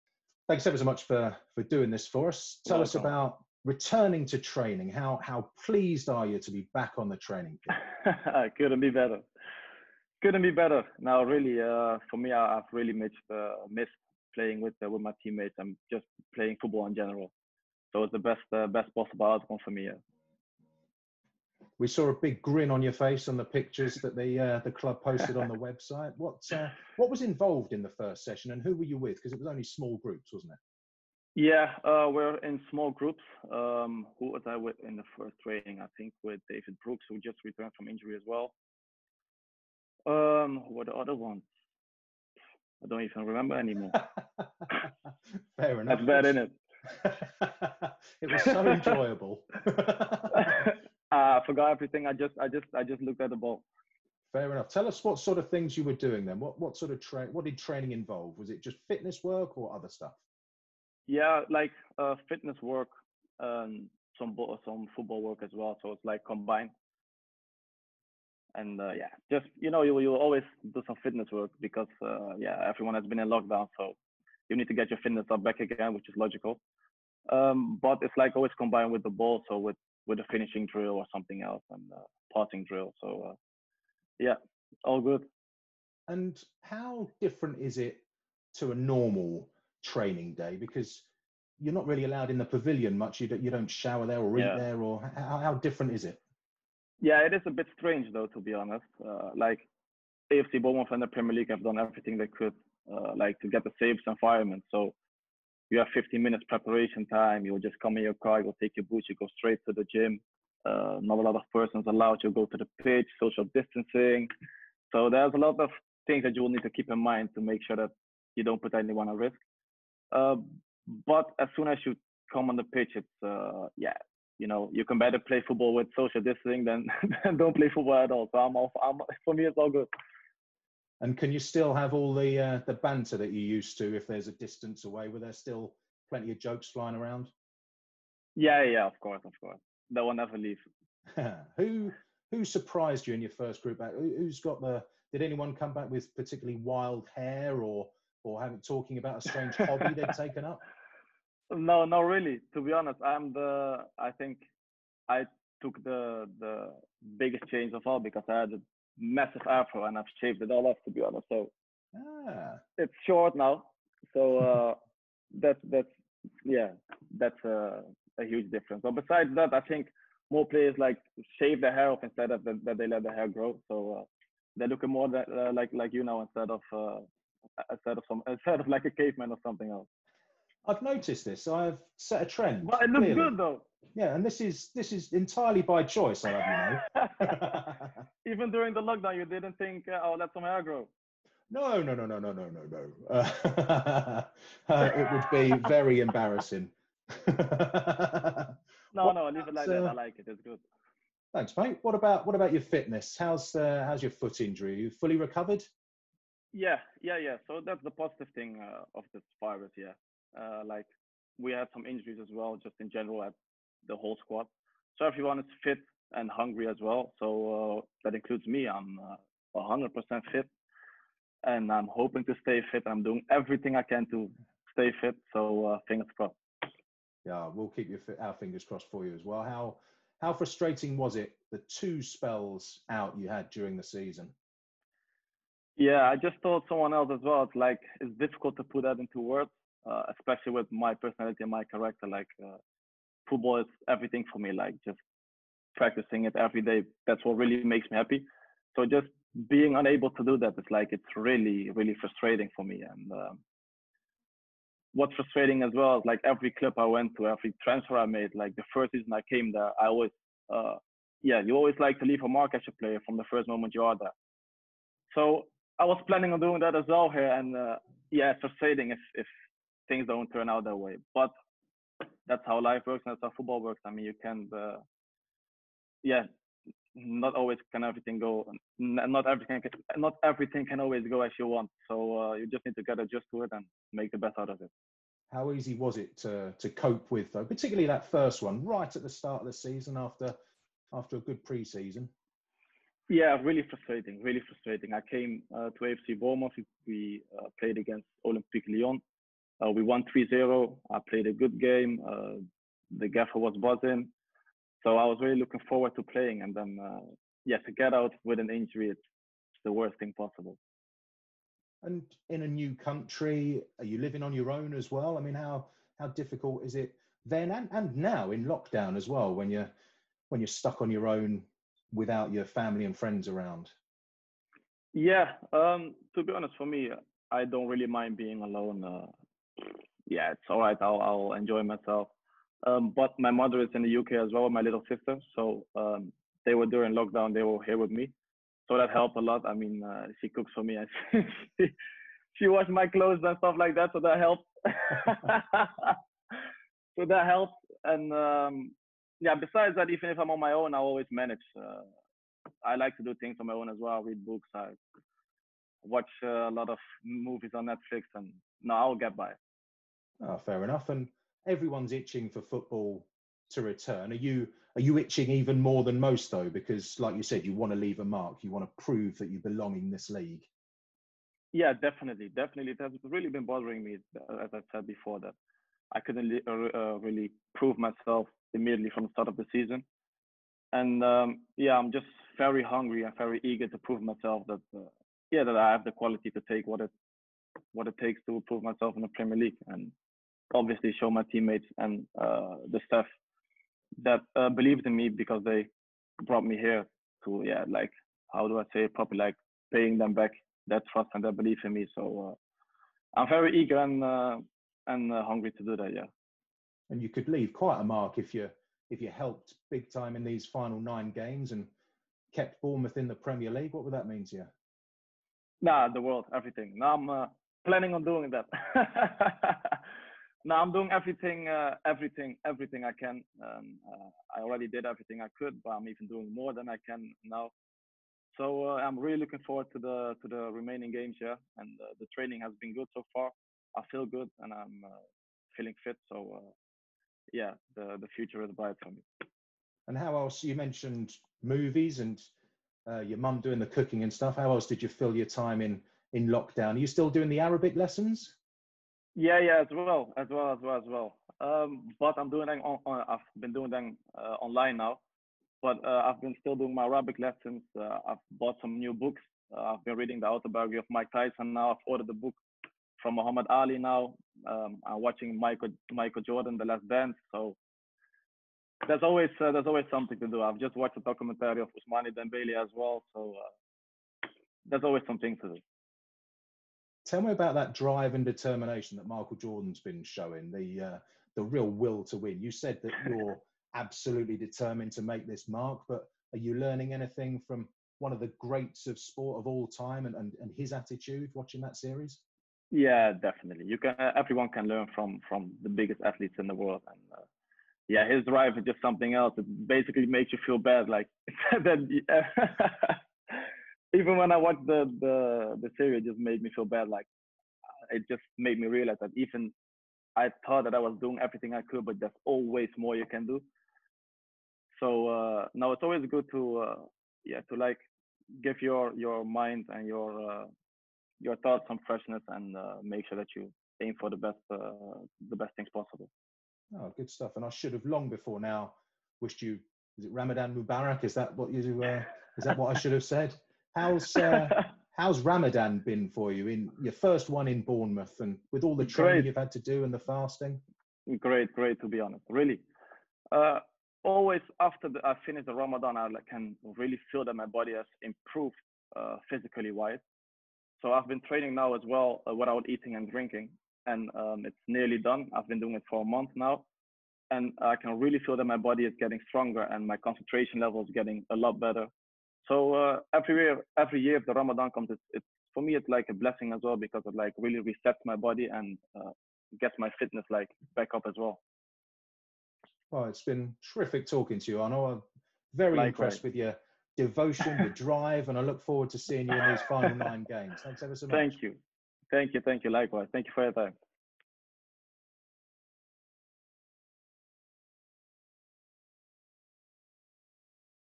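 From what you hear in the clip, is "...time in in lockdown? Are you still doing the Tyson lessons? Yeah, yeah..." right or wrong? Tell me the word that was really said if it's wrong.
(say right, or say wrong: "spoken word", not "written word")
wrong: "Arabic", not "Tyson".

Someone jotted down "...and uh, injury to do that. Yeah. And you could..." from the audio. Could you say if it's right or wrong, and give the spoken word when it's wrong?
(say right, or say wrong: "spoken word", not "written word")
wrong: "hungry", not "injury".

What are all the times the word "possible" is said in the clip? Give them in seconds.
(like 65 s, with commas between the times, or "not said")
18 s, 310 s, 525 s.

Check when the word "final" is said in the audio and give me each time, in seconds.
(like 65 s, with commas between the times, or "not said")
410 s, 579 s.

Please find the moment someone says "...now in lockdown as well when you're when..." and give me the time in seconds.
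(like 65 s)
317 s.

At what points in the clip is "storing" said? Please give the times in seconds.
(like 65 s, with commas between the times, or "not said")
not said.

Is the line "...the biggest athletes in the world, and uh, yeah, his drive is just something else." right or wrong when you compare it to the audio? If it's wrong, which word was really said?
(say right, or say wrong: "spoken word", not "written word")
right.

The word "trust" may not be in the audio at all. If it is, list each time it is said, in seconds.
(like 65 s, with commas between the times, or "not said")
400 s.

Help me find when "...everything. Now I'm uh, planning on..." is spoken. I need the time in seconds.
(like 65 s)
416 s.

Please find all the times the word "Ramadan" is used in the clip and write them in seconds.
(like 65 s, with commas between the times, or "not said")
530 s, 535 s, 545 s, 564 s.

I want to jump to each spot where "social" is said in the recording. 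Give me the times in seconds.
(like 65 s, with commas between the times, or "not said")
113 s, 125 s.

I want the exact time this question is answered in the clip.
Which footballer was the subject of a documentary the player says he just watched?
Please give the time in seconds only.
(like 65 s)
471 s.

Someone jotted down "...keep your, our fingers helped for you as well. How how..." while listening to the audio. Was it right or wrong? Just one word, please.
wrong.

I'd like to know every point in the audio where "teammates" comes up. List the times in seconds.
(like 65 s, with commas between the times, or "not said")
15 s, 391 s.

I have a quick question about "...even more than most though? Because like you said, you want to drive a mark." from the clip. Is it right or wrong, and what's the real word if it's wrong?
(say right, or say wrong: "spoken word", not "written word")
wrong: "leave", not "drive".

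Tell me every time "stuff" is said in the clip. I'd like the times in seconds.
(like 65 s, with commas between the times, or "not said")
59 s, 343 s, 444 s, 527 s.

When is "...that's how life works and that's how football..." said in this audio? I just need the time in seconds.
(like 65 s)
272 s.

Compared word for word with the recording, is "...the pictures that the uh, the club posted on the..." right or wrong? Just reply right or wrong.
right.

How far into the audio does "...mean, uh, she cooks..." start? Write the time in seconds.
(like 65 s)
339 s.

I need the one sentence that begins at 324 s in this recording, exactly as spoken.
Yeah, um, to be honest, for me, I don't really mind being alone.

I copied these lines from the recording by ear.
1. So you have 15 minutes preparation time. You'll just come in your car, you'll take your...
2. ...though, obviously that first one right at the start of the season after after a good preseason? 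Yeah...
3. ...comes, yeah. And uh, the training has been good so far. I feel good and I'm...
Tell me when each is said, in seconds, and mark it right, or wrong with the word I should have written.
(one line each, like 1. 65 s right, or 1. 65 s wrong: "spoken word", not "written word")
1. 104 s right
2. 287 s wrong: "particularly", not "obviously"
3. 430 s wrong: "games", not "comes".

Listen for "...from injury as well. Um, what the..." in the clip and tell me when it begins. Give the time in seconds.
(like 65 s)
37 s.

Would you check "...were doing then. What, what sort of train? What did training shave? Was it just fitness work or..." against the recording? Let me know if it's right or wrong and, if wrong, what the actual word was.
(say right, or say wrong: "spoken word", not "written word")
wrong: "involve", not "shave".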